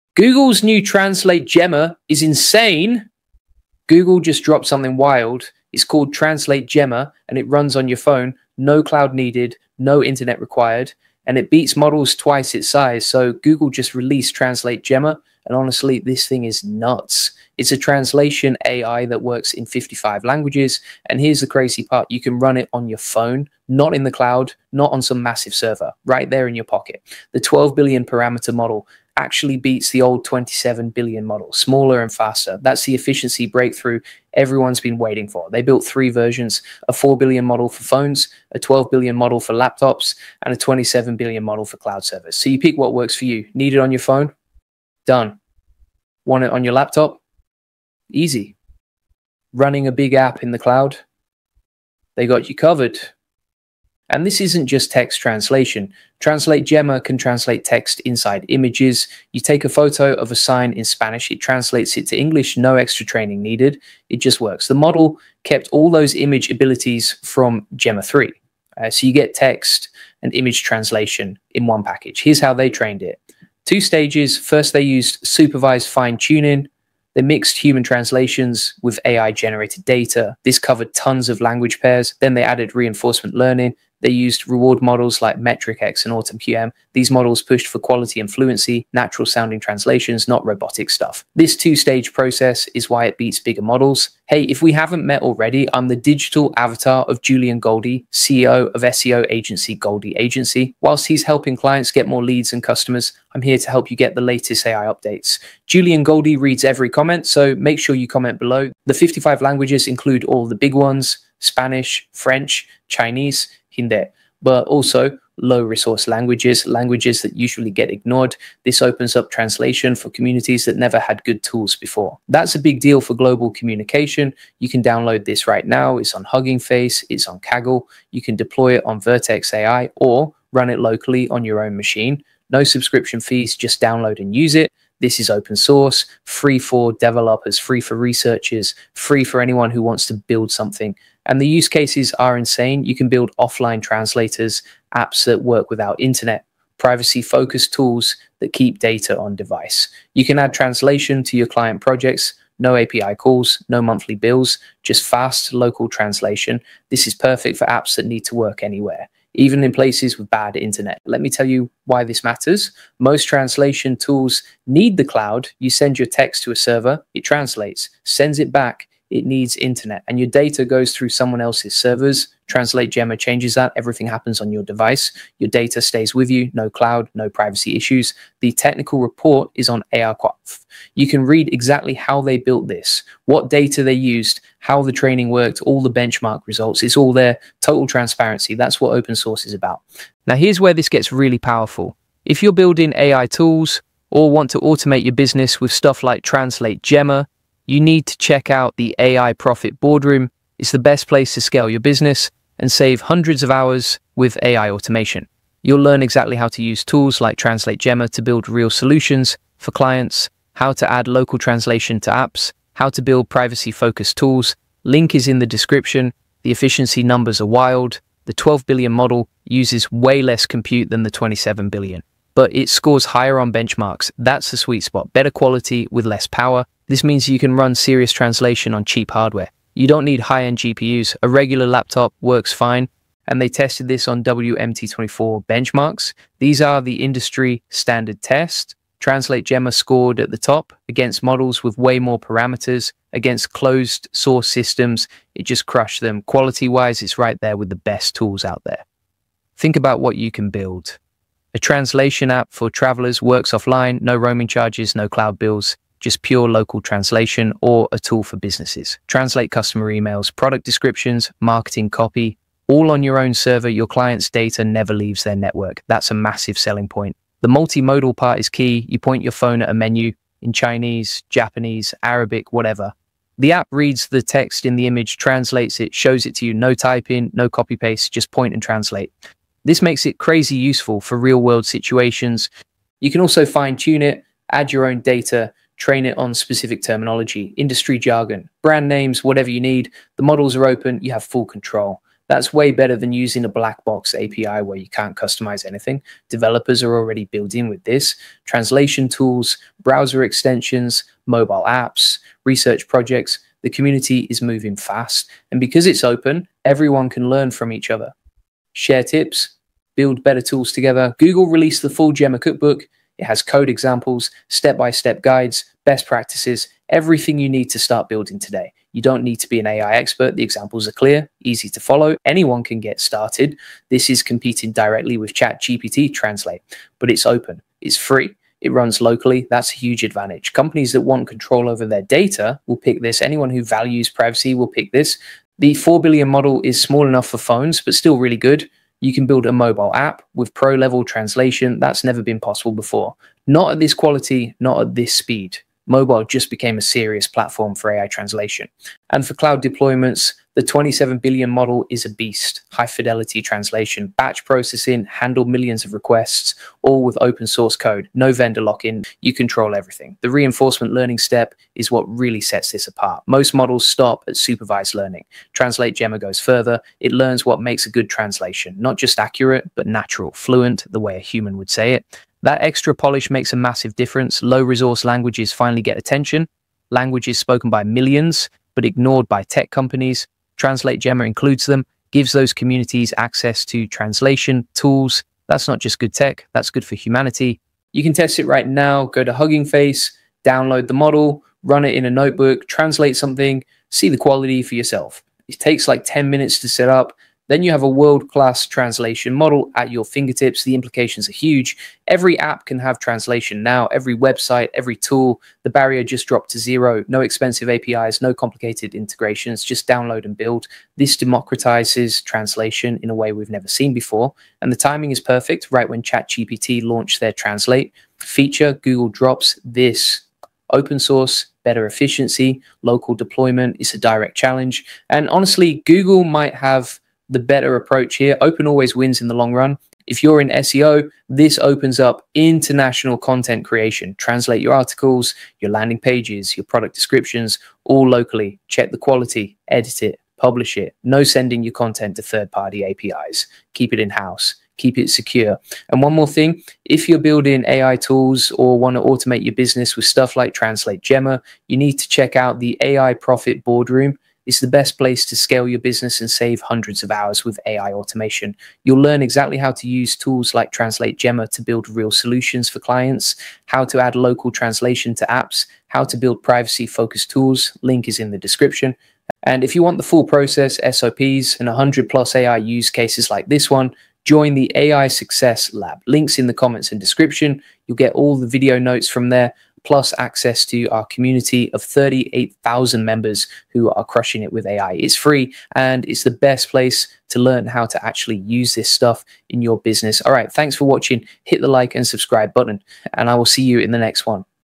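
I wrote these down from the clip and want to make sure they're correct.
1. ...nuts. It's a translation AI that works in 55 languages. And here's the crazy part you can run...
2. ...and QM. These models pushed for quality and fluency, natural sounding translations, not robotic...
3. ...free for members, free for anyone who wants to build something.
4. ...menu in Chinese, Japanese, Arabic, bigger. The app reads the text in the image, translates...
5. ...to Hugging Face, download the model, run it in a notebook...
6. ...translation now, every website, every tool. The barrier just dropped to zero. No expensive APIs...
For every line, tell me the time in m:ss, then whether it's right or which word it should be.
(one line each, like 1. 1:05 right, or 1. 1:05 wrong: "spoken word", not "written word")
1. 0:16 right
2. 1:26 right
3. 2:17 wrong: "researchers", not "members"
4. 4:29 wrong: "whatever", not "bigger"
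5. 6:29 right
6. 6:42 right.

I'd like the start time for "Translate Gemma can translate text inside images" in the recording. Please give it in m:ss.
0:56.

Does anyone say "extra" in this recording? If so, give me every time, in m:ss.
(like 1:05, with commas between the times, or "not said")
1:02, 6:12.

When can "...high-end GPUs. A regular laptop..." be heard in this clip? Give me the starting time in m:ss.
3:50.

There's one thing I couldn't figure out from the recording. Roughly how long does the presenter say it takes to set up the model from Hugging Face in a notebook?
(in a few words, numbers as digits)
10 minutes.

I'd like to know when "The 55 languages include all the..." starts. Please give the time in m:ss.
1:48.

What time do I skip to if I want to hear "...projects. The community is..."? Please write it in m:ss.
5:02.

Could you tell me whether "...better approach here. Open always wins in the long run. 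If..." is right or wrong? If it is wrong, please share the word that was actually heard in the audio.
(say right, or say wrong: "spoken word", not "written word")
right.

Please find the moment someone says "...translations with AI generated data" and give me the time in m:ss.
1:17.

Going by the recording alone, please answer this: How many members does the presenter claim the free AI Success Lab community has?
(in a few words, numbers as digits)
38,000.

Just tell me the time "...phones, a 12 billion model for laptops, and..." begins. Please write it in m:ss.
0:37.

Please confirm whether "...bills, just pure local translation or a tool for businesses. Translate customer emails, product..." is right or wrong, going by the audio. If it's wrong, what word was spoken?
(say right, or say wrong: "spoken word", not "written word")
right.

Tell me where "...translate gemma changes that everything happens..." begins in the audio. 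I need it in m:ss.
2:52.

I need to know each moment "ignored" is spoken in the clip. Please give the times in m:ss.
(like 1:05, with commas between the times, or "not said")
1:57, 6:18.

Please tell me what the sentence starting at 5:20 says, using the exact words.
The examples are clear, easy to follow.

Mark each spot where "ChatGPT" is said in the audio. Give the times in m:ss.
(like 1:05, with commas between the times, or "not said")
5:25, 6:56.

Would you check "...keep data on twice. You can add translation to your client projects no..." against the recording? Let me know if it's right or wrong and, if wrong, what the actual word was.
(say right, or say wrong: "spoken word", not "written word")
wrong: "device", not "twice".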